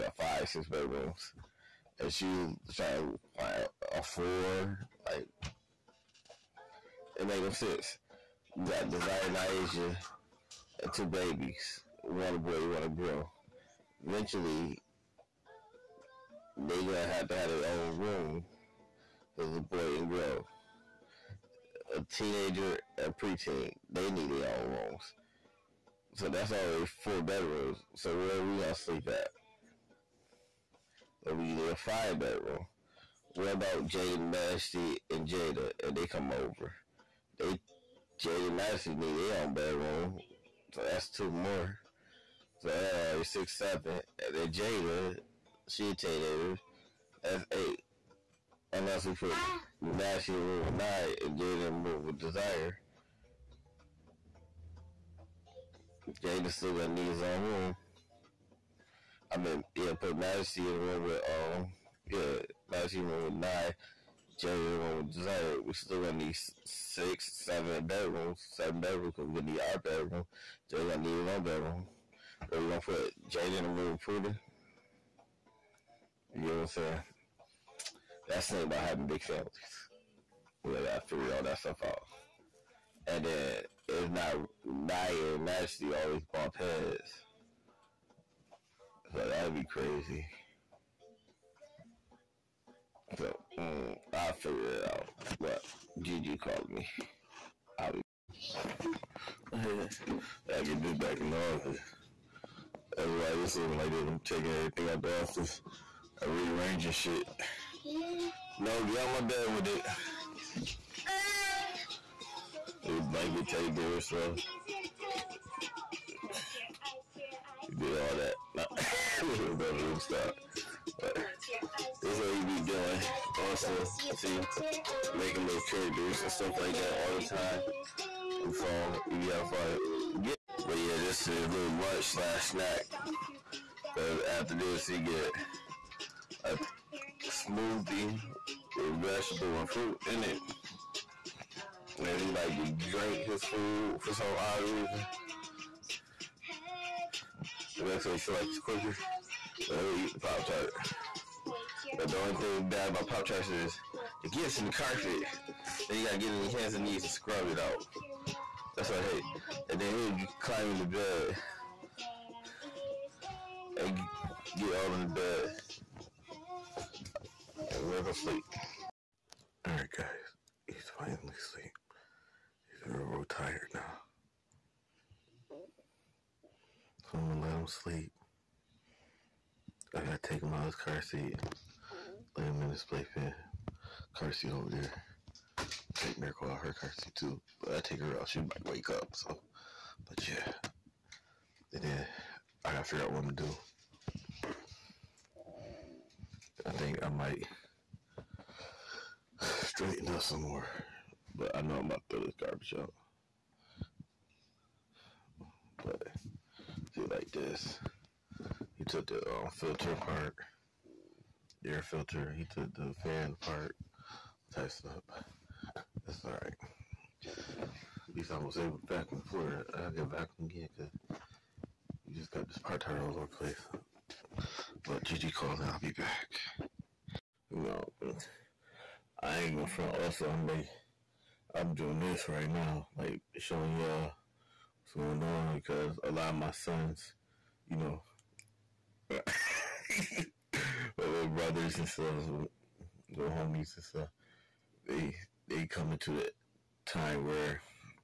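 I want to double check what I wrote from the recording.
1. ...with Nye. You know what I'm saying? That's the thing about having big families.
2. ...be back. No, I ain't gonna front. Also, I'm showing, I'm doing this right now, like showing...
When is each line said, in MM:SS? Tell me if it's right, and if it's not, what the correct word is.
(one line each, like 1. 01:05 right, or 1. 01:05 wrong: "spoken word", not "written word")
1. 01:13 wrong: "Porter", not "Nye"
2. 03:45 wrong: "making", not "showing".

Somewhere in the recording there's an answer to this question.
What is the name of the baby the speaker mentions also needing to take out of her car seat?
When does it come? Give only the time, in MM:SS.
03:06.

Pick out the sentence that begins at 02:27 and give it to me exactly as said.
I guess they feel like it's quicker.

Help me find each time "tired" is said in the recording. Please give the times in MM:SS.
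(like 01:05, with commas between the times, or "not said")
02:53, 03:42.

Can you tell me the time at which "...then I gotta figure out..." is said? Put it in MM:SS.
03:11.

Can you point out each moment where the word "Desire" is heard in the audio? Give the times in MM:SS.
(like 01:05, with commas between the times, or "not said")
00:08, 00:52, 01:05.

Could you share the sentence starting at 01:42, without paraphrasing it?
That's why this looking like this.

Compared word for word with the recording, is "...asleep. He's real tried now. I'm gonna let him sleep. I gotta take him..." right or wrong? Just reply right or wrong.
wrong.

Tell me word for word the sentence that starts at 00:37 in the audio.
They Jaden Massey need their own bedroom.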